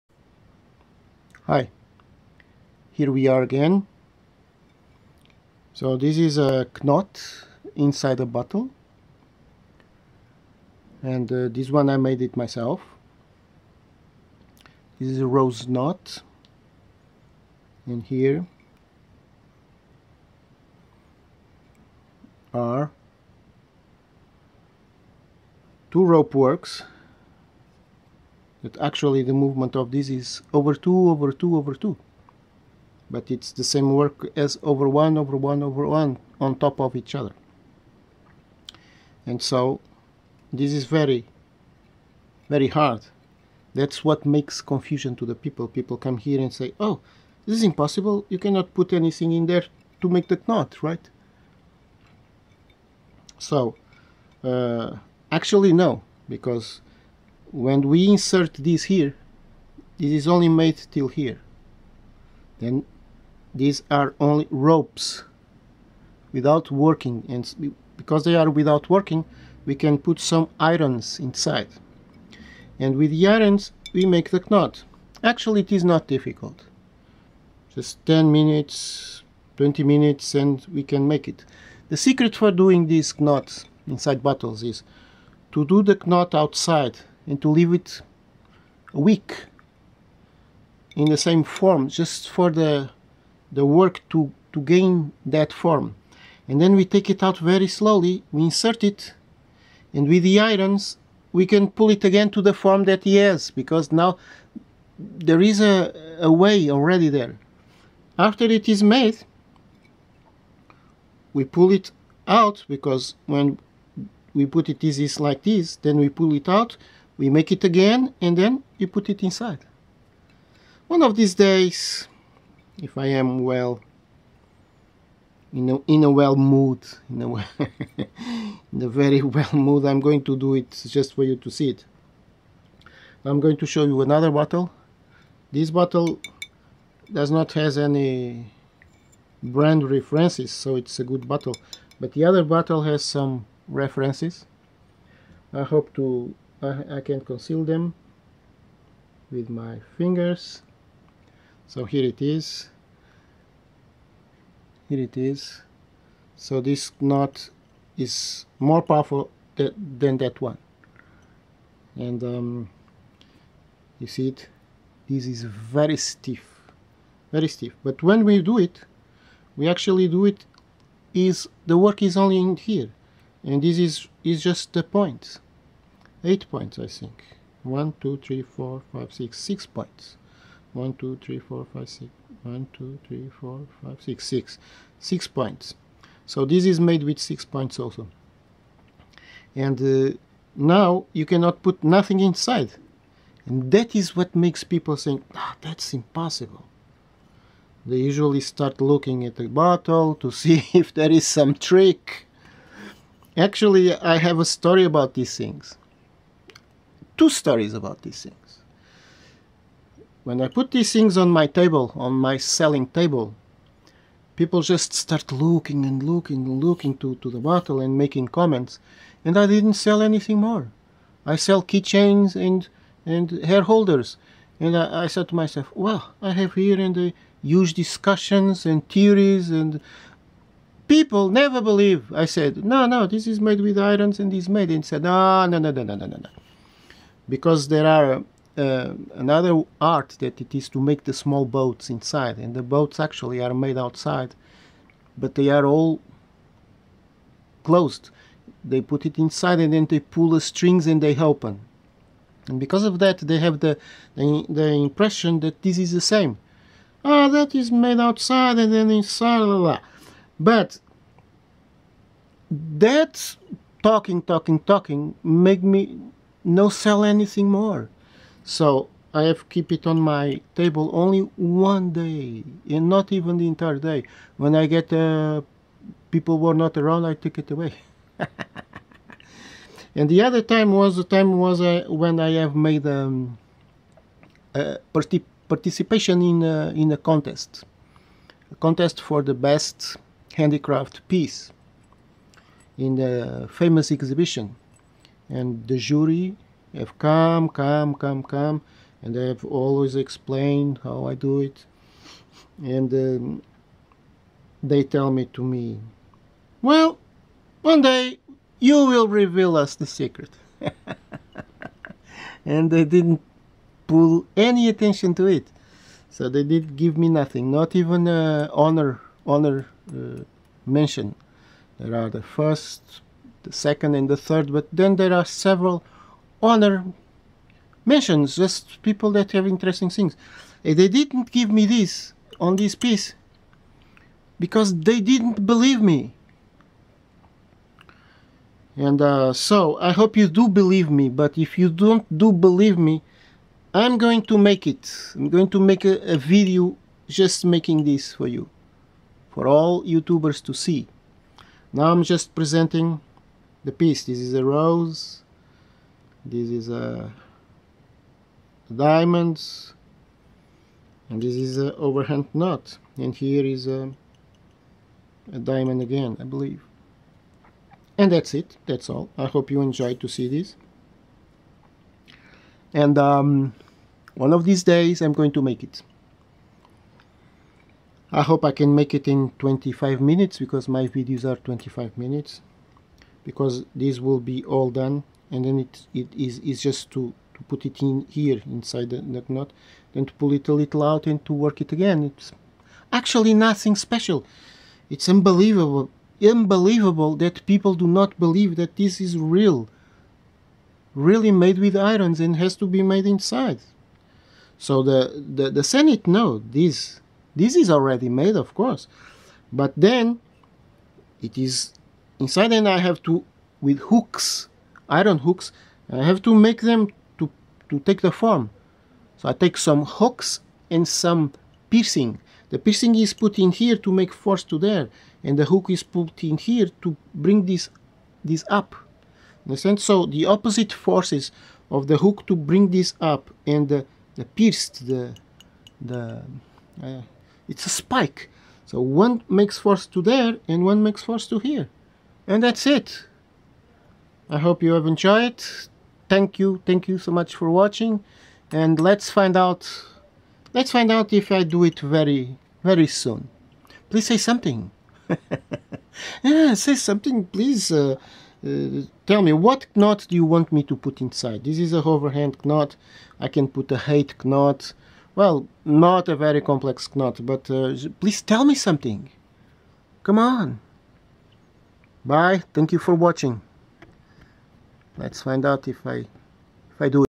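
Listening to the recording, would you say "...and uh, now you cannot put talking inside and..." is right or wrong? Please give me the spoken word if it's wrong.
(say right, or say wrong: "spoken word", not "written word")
wrong: "nothing", not "talking".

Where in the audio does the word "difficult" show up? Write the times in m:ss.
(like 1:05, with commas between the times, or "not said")
1:16.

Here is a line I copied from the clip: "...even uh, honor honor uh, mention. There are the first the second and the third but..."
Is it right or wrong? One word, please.
right.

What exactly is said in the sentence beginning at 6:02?
And here is a, a diamond again, I believe.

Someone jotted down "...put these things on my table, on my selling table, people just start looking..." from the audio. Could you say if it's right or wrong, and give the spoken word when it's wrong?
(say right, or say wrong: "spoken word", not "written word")
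right.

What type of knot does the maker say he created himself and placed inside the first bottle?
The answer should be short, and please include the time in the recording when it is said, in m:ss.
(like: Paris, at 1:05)
rose knot, at 0:15.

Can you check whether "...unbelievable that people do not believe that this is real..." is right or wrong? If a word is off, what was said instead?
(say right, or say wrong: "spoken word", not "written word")
right.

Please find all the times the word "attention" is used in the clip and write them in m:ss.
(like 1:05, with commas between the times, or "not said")
5:14.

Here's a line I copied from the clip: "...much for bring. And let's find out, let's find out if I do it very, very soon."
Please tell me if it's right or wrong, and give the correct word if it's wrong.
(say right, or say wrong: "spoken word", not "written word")
wrong: "watching", not "bring".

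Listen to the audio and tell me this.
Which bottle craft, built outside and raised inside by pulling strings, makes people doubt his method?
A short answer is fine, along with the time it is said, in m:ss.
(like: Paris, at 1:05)
small boats, at 4:01.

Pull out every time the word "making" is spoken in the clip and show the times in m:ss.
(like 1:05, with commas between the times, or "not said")
3:37, 5:47.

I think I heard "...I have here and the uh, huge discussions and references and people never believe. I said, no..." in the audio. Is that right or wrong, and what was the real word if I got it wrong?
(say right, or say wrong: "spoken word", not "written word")
wrong: "theories", not "references".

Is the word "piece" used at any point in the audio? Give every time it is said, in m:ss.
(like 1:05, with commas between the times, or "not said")
4:51, 5:32, 5:53.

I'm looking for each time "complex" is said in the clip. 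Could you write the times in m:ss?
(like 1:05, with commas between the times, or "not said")
7:46.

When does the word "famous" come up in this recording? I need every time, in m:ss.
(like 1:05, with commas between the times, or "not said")
4:53.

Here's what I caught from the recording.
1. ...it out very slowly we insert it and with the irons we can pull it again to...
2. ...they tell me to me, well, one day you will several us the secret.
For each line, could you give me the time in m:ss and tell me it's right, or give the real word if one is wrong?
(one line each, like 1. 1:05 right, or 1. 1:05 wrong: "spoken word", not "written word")
1. 1:37 right
2. 5:04 wrong: "reveal", not "several".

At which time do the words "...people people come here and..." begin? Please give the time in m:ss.
0:45.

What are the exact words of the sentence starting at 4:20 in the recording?
but that talking talking talking make me no sell anything more.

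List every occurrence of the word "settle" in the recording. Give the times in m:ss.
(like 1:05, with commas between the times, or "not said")
not said.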